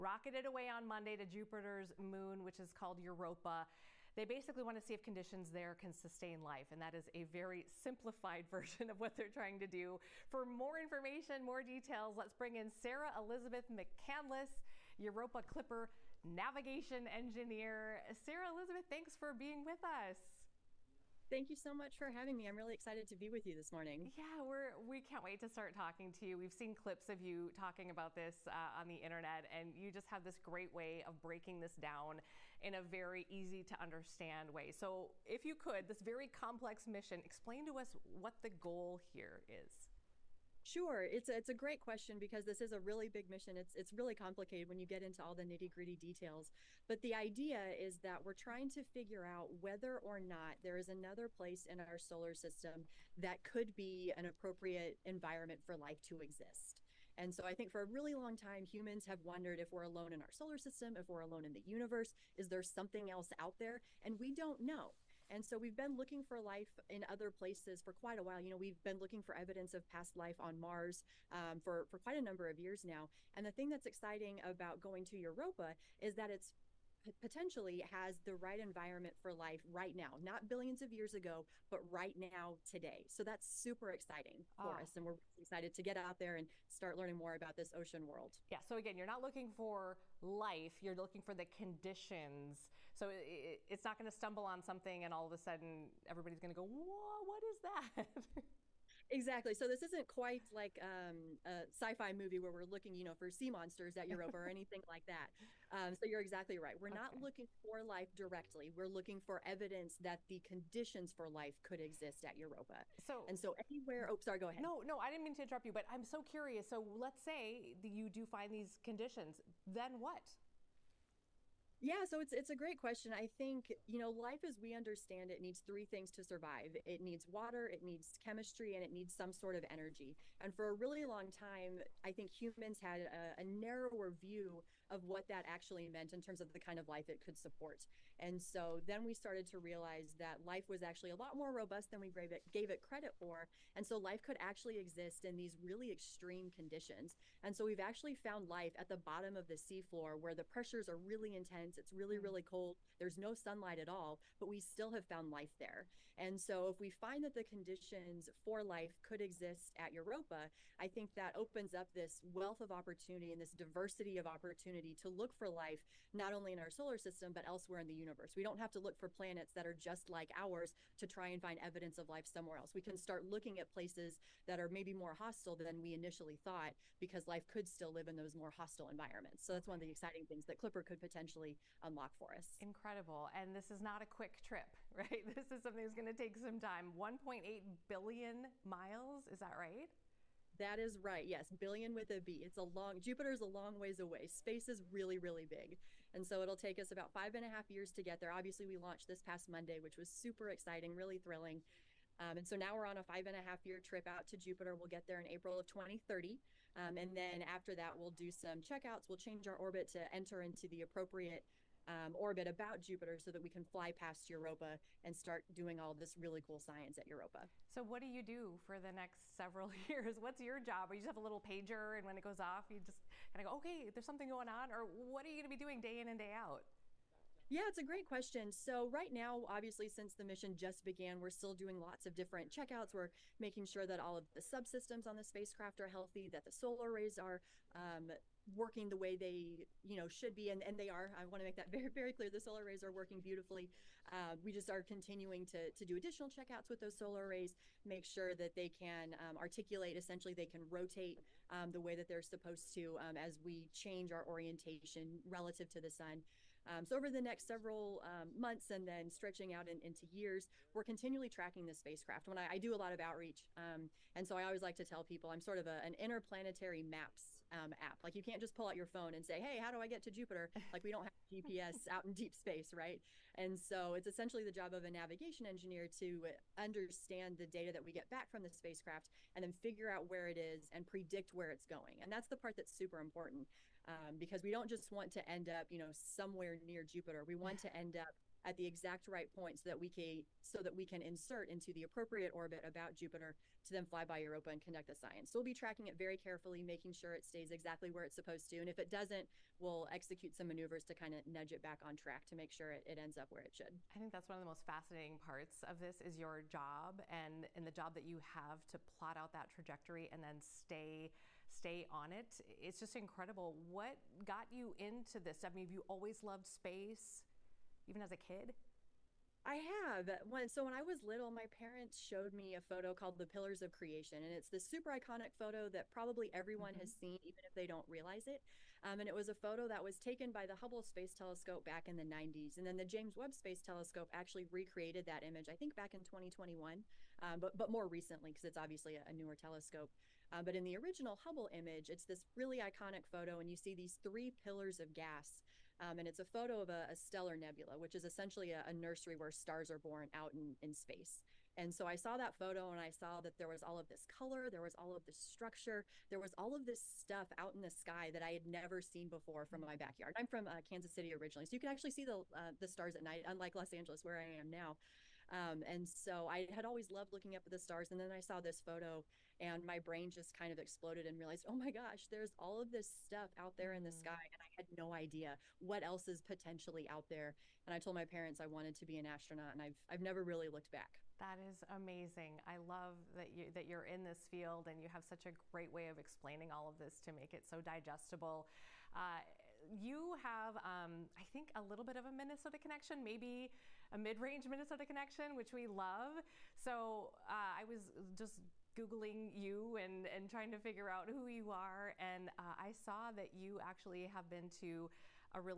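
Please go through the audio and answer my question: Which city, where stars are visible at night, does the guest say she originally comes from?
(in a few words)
Kansas City.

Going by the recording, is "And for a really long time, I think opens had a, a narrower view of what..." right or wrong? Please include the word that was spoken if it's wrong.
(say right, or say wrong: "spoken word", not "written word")
wrong: "humans", not "opens".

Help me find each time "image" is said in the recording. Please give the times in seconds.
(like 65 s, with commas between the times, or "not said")
335 s, 341 s.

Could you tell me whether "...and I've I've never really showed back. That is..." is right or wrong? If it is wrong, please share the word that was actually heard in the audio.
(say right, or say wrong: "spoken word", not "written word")
wrong: "looked", not "showed".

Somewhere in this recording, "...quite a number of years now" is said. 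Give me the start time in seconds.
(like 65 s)
71 s.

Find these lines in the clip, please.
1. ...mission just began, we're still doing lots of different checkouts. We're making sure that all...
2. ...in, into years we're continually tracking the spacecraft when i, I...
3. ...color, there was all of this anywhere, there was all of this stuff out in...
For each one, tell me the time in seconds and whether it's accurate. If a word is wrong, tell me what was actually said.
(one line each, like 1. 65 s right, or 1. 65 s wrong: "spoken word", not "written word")
1. 230 s right
2. 259 s right
3. 354 s wrong: "structure", not "anywhere".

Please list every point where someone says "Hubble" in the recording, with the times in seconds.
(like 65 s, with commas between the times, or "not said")
330 s, 341 s.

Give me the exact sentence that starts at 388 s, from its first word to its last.
Uh, you have, um, I think, a little bit of a Minnesota connection, maybe a mid-range Minnesota connection, which we love.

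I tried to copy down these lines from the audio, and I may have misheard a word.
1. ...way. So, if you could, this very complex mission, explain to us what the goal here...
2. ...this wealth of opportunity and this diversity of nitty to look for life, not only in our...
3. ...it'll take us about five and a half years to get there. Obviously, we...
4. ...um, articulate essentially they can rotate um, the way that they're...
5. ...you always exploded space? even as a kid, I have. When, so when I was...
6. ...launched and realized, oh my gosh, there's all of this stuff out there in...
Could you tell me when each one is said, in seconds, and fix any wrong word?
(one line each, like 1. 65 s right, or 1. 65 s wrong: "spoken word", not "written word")
1. 34 s right
2. 161 s wrong: "opportunity", not "nitty"
3. 196 s right
4. 249 s right
5. 315 s wrong: "loved", not "exploded"
6. 370 s wrong: "exploded", not "launched".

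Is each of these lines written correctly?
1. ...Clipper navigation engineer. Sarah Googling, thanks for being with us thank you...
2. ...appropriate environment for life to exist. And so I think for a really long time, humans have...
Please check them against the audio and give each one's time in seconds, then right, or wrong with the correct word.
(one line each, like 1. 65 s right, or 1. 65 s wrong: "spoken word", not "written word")
1. 15 s wrong: "Elizabeth", not "Googling"
2. 54 s right.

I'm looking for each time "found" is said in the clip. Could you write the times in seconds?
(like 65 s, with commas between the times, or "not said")
148 s, 155 s.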